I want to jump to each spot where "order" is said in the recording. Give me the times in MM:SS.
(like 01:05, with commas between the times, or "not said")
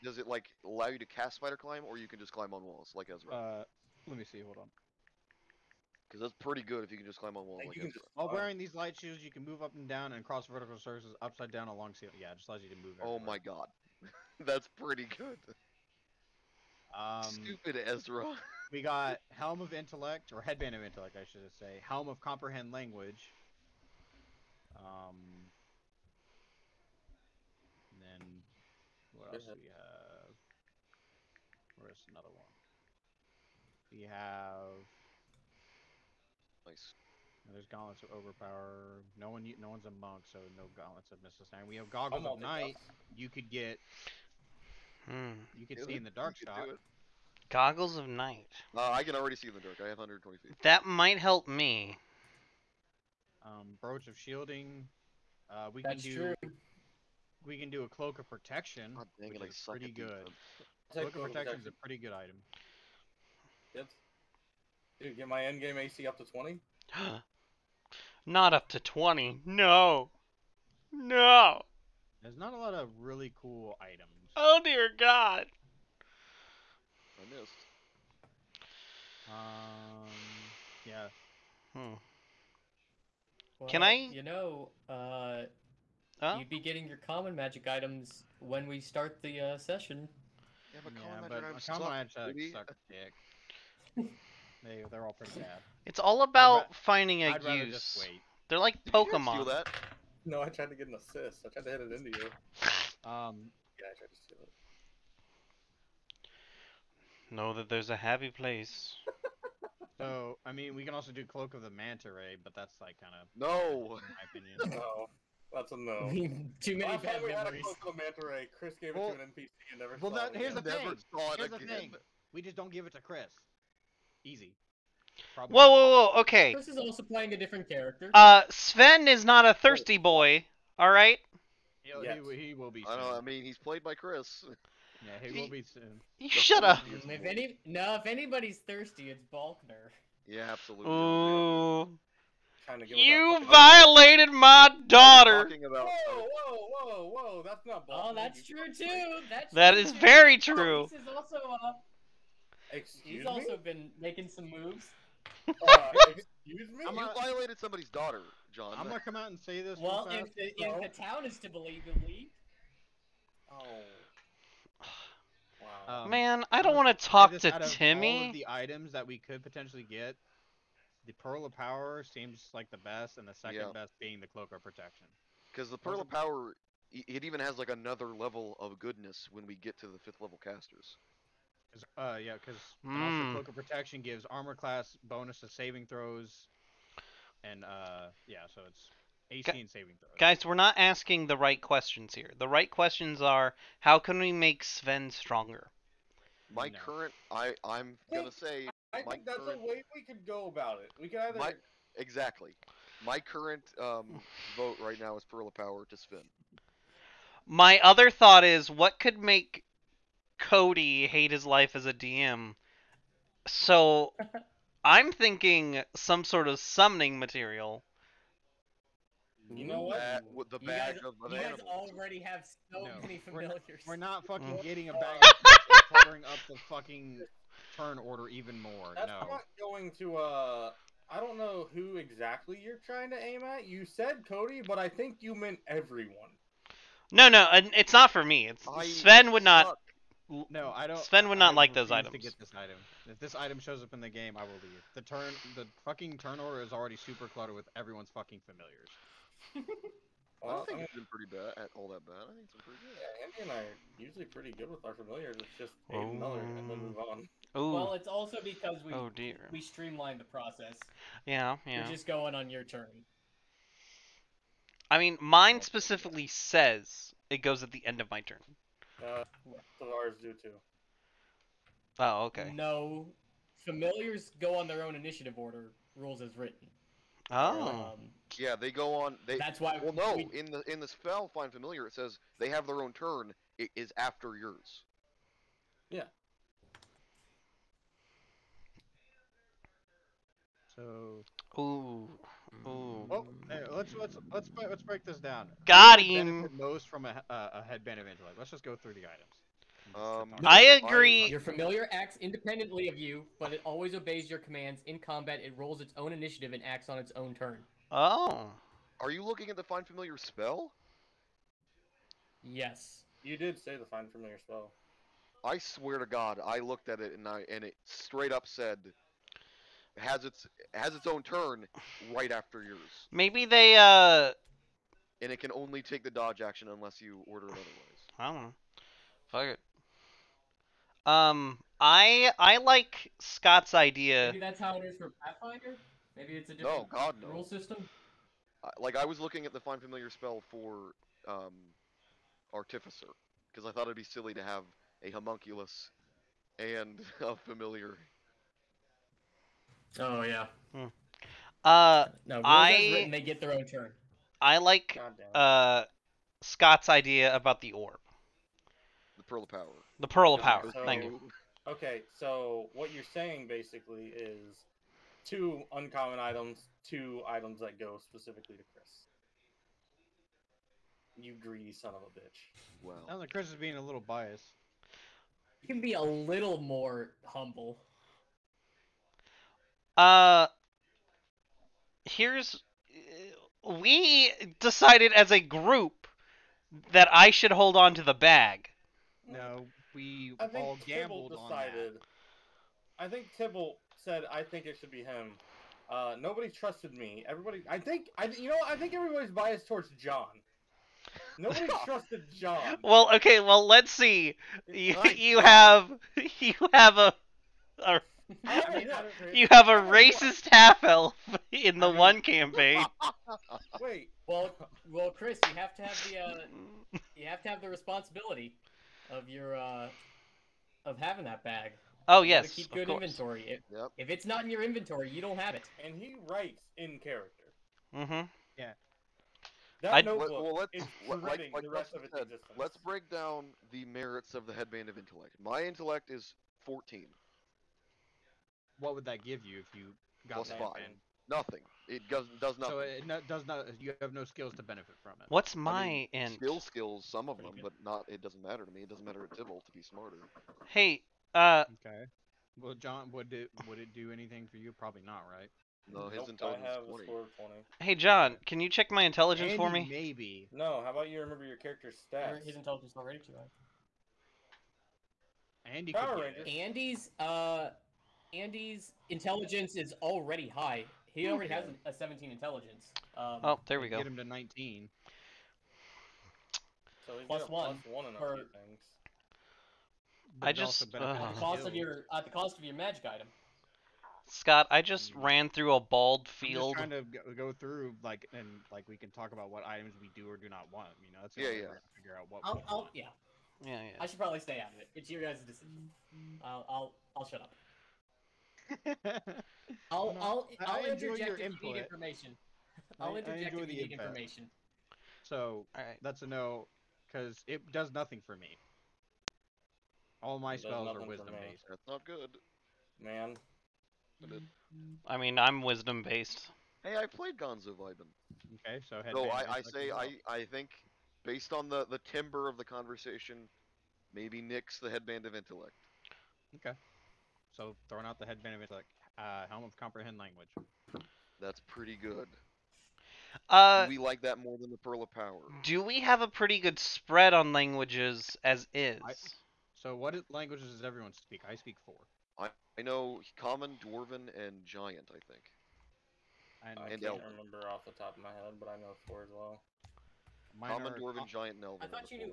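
03:47, 04:06, 04:35, 05:27.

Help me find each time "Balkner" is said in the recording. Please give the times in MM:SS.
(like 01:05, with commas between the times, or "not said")
02:19, 02:27.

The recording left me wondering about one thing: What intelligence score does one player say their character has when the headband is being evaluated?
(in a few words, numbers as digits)
14.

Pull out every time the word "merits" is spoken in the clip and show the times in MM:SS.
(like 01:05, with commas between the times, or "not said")
07:13.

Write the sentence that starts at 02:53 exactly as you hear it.
best being the Cloak of Protection.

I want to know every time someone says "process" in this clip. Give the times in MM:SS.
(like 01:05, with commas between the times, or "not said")
04:20.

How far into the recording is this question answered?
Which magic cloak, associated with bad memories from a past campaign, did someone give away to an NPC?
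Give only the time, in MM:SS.
01:51.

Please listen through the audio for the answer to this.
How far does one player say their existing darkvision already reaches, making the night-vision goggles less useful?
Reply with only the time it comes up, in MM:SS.
00:49.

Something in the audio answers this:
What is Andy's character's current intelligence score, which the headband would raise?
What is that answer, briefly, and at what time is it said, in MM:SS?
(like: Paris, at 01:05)
17, at 07:51.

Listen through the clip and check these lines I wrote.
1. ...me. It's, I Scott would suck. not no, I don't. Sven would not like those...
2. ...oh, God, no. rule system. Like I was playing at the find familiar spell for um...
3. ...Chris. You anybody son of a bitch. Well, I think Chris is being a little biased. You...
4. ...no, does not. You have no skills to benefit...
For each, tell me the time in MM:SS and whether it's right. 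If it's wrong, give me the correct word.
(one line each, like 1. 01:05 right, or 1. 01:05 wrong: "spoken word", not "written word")
1. 03:58 wrong: "Sven", not "Scott"
2. 05:36 wrong: "looking", not "playing"
3. 06:08 wrong: "greedy", not "anybody"
4. 07:23 right.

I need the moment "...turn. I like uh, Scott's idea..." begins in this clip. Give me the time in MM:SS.
05:53.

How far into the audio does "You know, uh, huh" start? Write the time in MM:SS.
01:23.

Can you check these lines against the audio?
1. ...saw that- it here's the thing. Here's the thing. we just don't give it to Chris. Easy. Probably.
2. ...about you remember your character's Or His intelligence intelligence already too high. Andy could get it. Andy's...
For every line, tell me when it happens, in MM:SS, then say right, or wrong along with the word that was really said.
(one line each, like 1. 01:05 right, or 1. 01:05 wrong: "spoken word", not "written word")
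1. 02:00 right
2. 07:40 right.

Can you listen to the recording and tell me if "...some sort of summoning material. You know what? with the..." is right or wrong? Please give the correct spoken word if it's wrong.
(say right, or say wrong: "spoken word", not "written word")
right.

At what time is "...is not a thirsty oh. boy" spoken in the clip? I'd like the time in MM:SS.
02:09.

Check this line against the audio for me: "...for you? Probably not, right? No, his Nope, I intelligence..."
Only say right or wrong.
right.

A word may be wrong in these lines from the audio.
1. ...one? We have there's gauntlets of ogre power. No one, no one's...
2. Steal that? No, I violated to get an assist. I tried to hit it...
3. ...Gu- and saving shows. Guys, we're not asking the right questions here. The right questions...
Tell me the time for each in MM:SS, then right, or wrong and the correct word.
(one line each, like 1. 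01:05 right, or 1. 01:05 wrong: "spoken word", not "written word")
1. 00:32 right
2. 01:39 wrong: "tried", not "violated"
3. 03:09 wrong: "throws", not "shows".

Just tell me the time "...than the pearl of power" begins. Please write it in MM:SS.
08:54.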